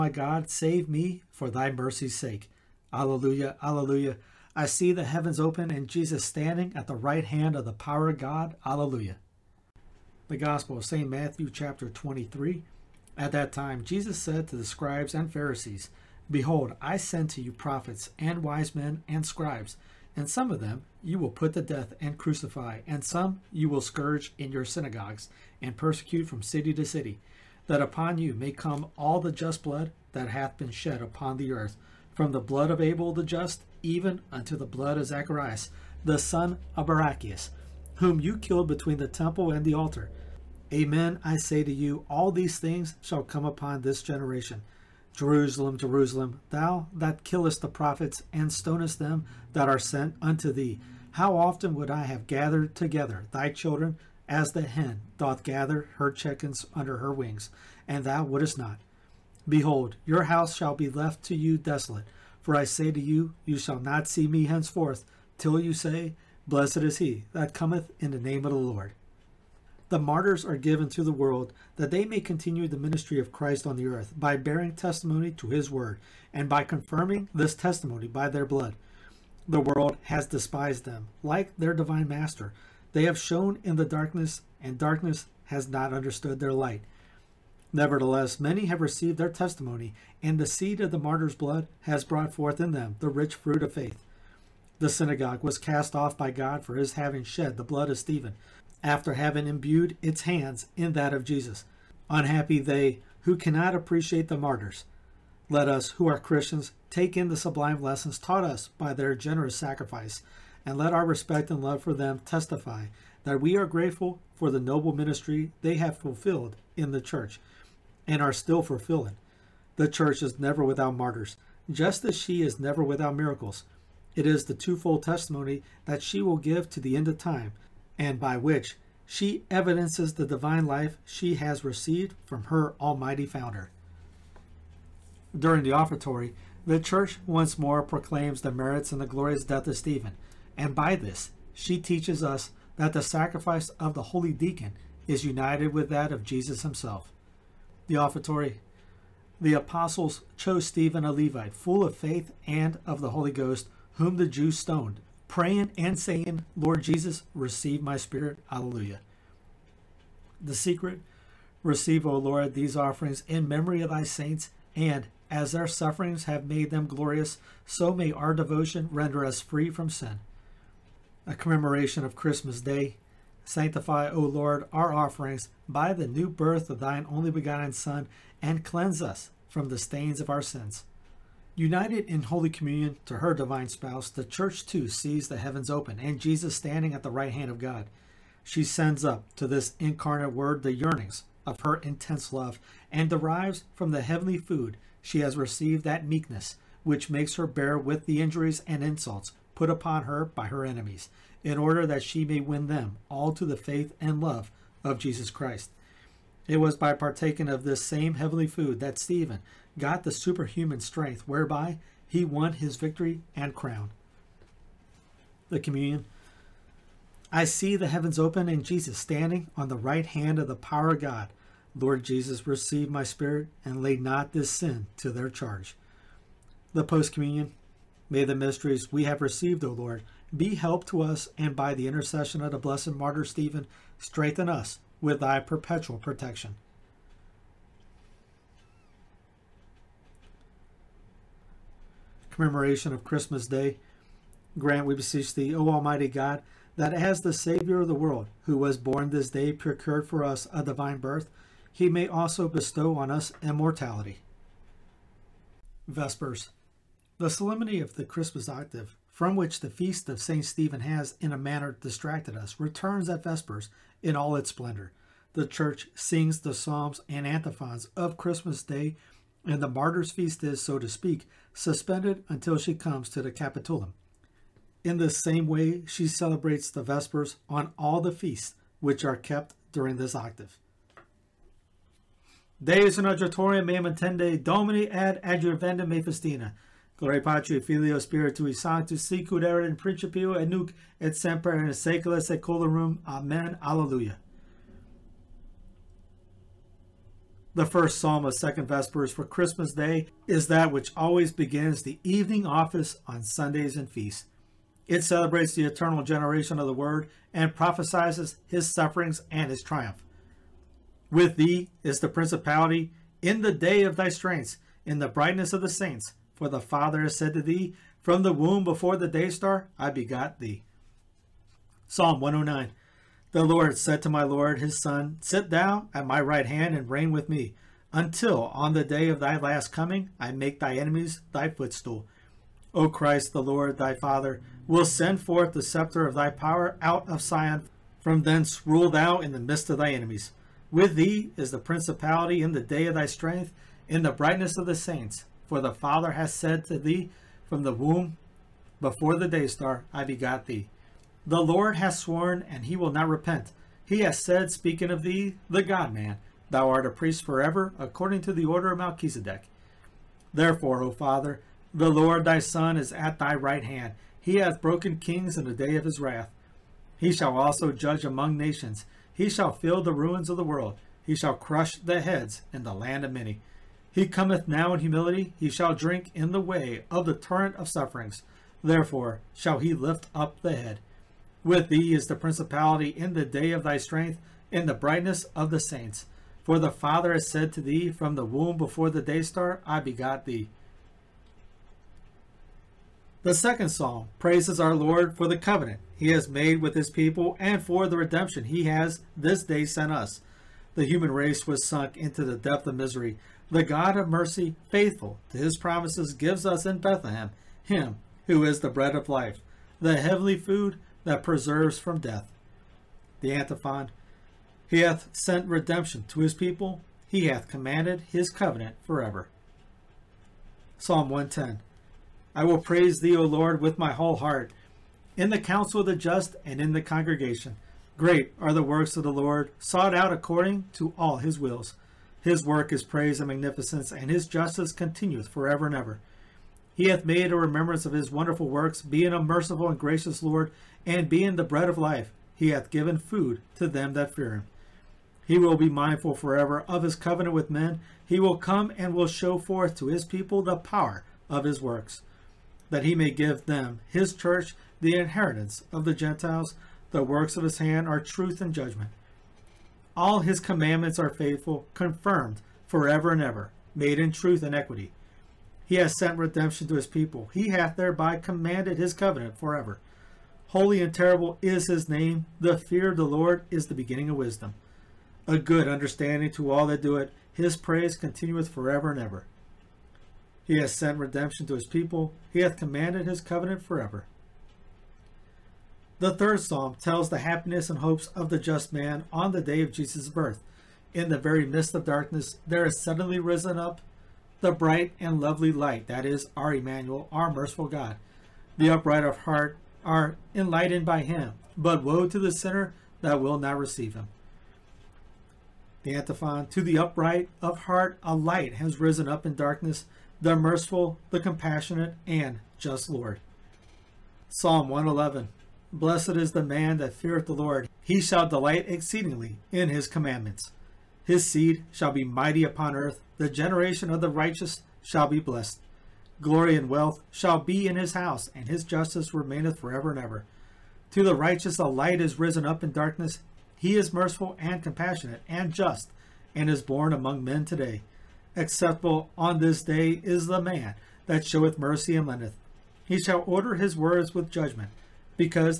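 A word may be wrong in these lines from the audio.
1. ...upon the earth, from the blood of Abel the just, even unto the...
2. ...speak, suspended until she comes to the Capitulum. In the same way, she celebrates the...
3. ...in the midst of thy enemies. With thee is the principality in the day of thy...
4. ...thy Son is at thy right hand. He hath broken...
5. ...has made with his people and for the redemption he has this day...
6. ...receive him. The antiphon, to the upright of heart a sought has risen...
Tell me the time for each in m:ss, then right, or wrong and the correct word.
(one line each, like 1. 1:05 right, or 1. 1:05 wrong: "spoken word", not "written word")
1. 0:31 right
2. 4:30 right
3. 5:39 right
4. 6:02 right
5. 6:36 right
6. 8:23 wrong: "light", not "sought".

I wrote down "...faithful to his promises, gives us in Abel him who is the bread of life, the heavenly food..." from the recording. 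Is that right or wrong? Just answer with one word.
wrong.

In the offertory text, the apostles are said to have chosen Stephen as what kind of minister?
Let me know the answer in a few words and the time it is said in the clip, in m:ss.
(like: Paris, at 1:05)
a Levite, at 2:31.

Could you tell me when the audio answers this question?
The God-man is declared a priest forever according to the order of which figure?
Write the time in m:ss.
5:58.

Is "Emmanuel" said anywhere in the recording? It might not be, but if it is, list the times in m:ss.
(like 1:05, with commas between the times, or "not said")
8:16.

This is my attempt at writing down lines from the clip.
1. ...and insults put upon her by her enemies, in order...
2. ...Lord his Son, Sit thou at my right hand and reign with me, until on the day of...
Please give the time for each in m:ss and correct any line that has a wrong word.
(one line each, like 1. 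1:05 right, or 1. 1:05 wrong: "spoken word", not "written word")
1. 3:18 right
2. 5:24 right.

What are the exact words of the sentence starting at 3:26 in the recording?
It was by partaking of this same heavenly food that Stephen got the superhuman strength whereby he won his victory and crown.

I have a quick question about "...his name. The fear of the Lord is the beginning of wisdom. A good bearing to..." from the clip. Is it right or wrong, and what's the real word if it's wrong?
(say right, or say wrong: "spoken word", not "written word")
wrong: "understanding", not "bearing".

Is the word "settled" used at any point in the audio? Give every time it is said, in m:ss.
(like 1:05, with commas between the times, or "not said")
not said.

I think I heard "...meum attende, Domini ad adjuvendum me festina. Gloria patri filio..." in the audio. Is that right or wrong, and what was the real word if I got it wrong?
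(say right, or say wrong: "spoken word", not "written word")
right.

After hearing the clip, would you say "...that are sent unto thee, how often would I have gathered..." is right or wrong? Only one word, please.
right.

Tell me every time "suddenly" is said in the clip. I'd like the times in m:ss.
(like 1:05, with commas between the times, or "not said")
8:12.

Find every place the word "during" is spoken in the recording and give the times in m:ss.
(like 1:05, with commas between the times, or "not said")
2:15, 4:39.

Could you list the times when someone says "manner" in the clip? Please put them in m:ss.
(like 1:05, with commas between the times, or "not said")
4:21.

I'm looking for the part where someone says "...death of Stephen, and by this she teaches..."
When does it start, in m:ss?
2:19.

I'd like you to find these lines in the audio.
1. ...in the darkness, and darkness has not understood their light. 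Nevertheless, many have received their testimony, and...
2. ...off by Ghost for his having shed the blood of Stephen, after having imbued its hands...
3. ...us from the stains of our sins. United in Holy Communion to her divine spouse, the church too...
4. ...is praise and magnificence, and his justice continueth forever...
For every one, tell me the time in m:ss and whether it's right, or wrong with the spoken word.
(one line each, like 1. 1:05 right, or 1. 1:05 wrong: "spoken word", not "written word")
1. 1:23 right
2. 1:35 wrong: "God", not "Ghost"
3. 2:59 right
4. 7:12 right.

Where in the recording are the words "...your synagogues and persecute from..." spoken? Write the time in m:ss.
0:24.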